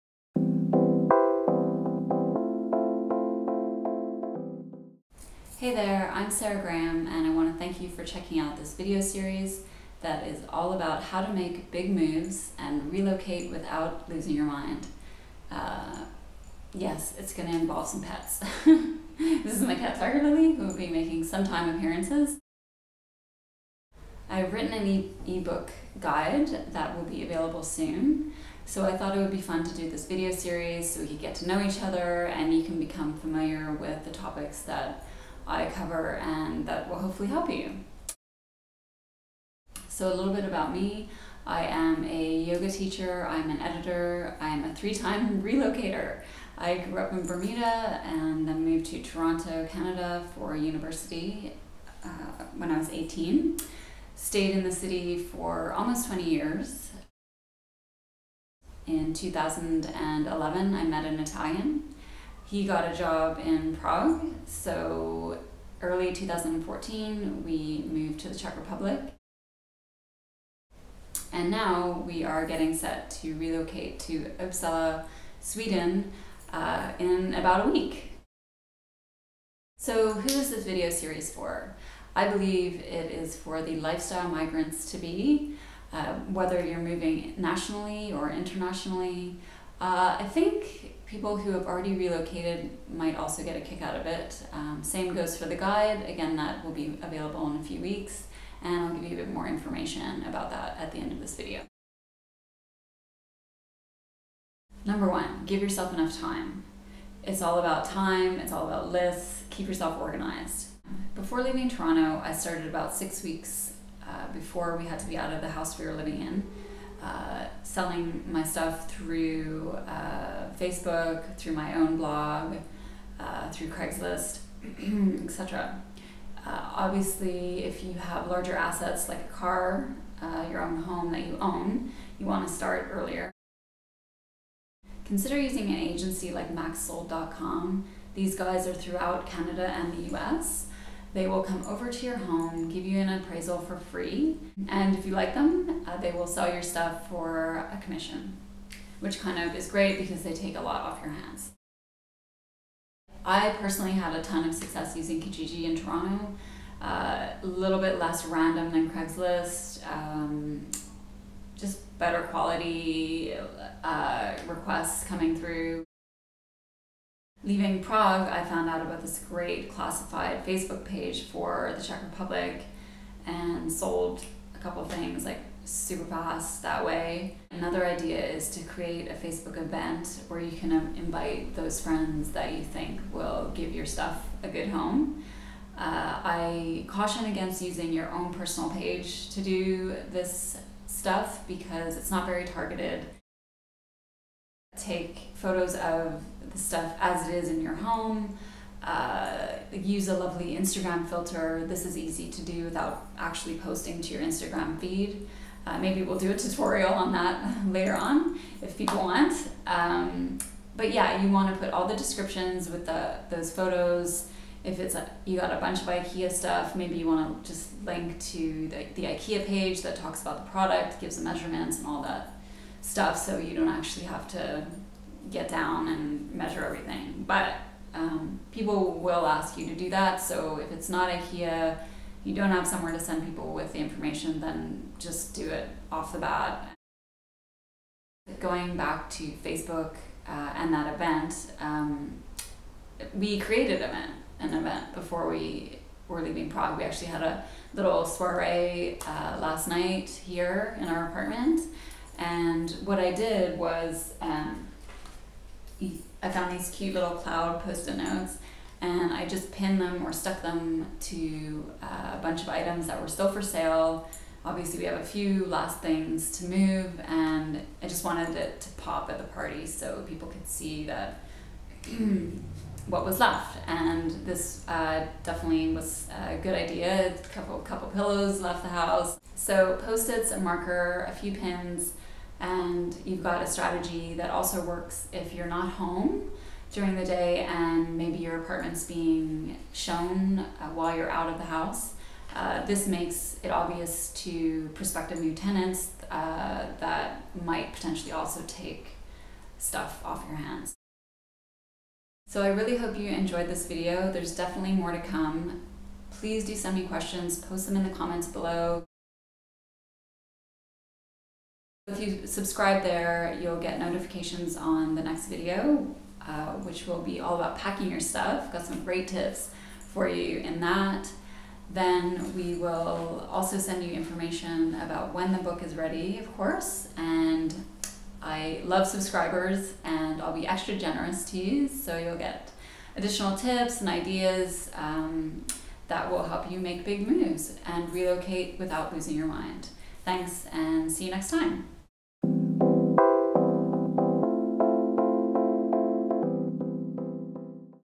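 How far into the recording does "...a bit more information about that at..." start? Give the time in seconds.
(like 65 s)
99 s.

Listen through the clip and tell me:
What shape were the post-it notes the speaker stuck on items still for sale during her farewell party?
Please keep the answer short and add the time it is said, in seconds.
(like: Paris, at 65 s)
Cloud, at 257 s.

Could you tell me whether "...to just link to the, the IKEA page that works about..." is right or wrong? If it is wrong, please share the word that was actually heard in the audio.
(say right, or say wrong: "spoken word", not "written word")
wrong: "talks", not "works".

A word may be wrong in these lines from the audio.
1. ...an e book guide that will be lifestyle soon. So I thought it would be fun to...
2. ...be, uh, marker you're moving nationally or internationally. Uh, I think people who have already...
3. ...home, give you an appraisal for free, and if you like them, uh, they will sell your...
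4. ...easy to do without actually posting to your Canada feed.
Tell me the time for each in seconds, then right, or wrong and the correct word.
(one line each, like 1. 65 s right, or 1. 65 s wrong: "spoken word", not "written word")
1. 24 s wrong: "available", not "lifestyle"
2. 84 s wrong: "whether", not "marker"
3. 142 s right
4. 201 s wrong: "Instagram", not "Canada".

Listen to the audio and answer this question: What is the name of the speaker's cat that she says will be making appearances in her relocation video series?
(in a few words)
Tiger Lily.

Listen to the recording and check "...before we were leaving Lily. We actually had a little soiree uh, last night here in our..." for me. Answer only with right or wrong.
wrong.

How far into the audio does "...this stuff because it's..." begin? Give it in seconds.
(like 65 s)
190 s.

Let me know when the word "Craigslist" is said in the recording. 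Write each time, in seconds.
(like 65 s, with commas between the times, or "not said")
123 s, 158 s.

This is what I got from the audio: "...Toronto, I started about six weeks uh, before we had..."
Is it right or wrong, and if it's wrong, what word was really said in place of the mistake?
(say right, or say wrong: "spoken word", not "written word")
right.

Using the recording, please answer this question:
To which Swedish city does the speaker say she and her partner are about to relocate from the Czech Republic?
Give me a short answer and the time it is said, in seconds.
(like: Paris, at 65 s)
Uppsala, at 74 s.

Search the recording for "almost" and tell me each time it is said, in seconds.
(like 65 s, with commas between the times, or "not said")
55 s.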